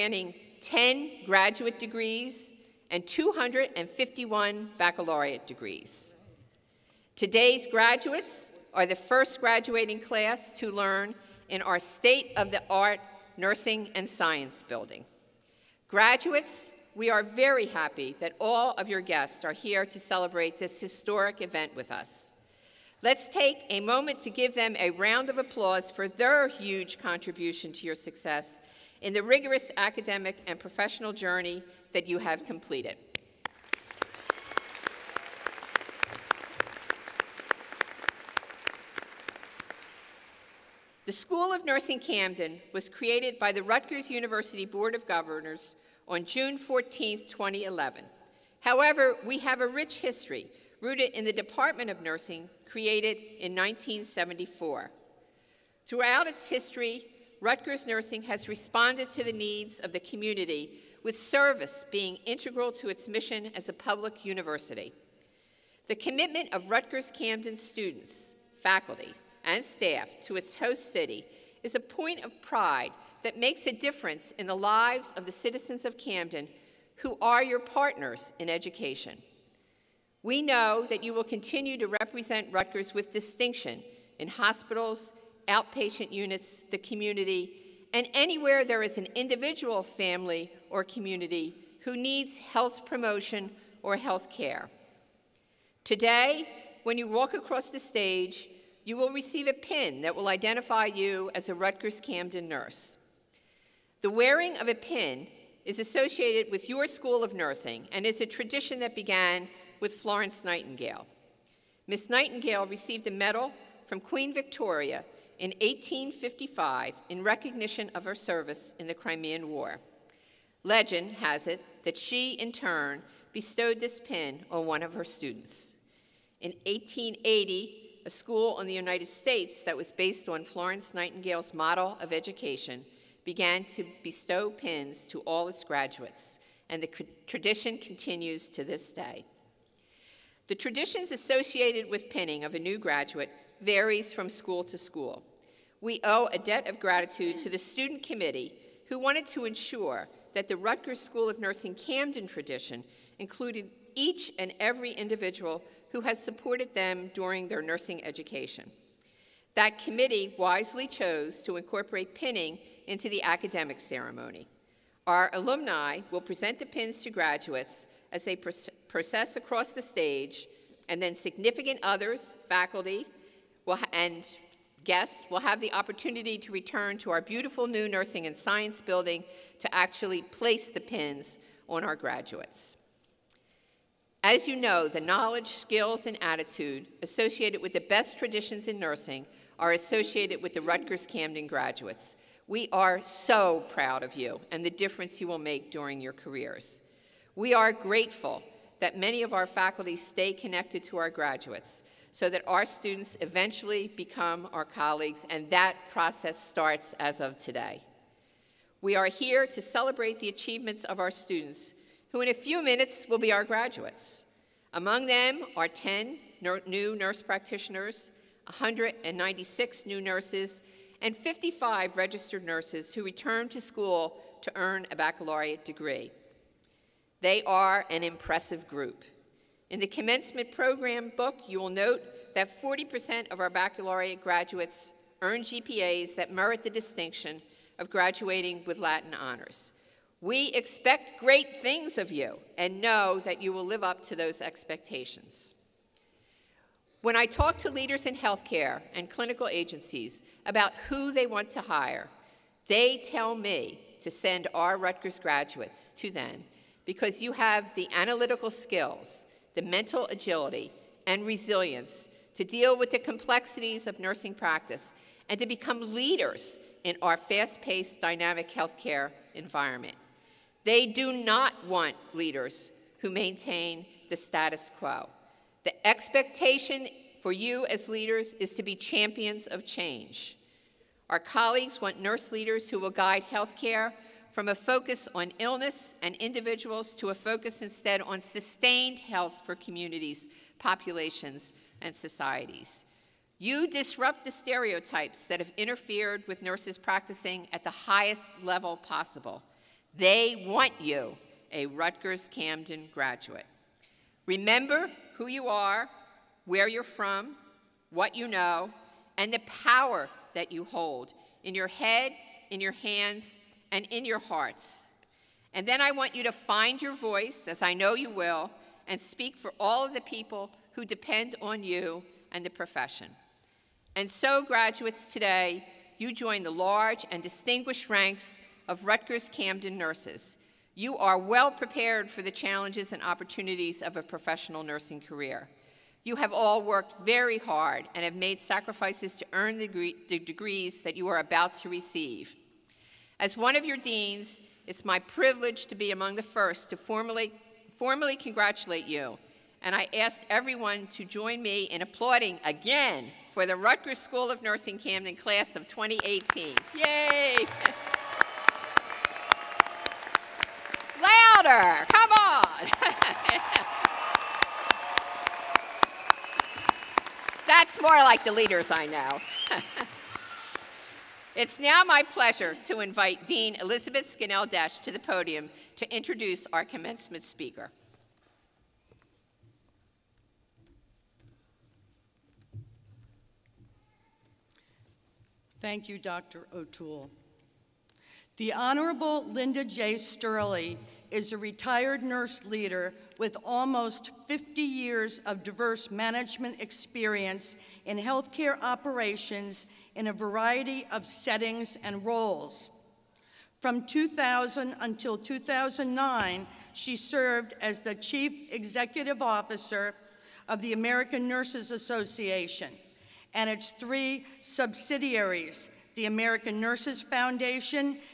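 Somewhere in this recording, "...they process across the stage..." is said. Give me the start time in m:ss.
2:48.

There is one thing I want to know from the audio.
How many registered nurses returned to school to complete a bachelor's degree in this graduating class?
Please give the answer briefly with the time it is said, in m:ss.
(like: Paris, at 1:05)
55, at 3:41.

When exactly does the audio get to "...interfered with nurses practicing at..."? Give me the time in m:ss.
4:55.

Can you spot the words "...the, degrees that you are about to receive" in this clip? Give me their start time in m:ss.
5:40.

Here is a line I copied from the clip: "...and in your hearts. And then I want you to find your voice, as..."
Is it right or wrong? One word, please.
right.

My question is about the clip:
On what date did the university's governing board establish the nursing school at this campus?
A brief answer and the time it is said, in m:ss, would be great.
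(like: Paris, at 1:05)
June 14, 2011, at 0:46.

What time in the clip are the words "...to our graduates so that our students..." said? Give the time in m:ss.
3:20.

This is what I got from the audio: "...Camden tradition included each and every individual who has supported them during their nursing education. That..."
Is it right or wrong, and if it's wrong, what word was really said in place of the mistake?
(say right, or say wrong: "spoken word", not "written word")
right.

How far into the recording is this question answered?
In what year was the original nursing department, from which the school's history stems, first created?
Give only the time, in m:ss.
0:53.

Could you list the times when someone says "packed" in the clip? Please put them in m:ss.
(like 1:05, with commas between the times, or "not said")
not said.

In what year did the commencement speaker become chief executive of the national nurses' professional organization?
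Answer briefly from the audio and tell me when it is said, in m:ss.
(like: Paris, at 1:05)
2000, at 6:43.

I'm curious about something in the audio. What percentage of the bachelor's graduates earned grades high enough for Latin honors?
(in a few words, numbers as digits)
40%.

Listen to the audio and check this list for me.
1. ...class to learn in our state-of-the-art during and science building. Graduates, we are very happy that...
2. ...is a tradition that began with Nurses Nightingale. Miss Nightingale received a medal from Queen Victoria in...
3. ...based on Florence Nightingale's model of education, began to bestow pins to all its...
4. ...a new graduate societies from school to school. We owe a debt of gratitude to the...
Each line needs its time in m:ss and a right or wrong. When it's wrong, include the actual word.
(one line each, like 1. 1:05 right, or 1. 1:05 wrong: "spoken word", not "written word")
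1. 0:09 wrong: "nursing", not "during"
2. 1:48 wrong: "Florence", not "Nurses"
3. 2:09 right
4. 2:22 wrong: "varies", not "societies".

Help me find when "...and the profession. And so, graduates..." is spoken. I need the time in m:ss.
5:22.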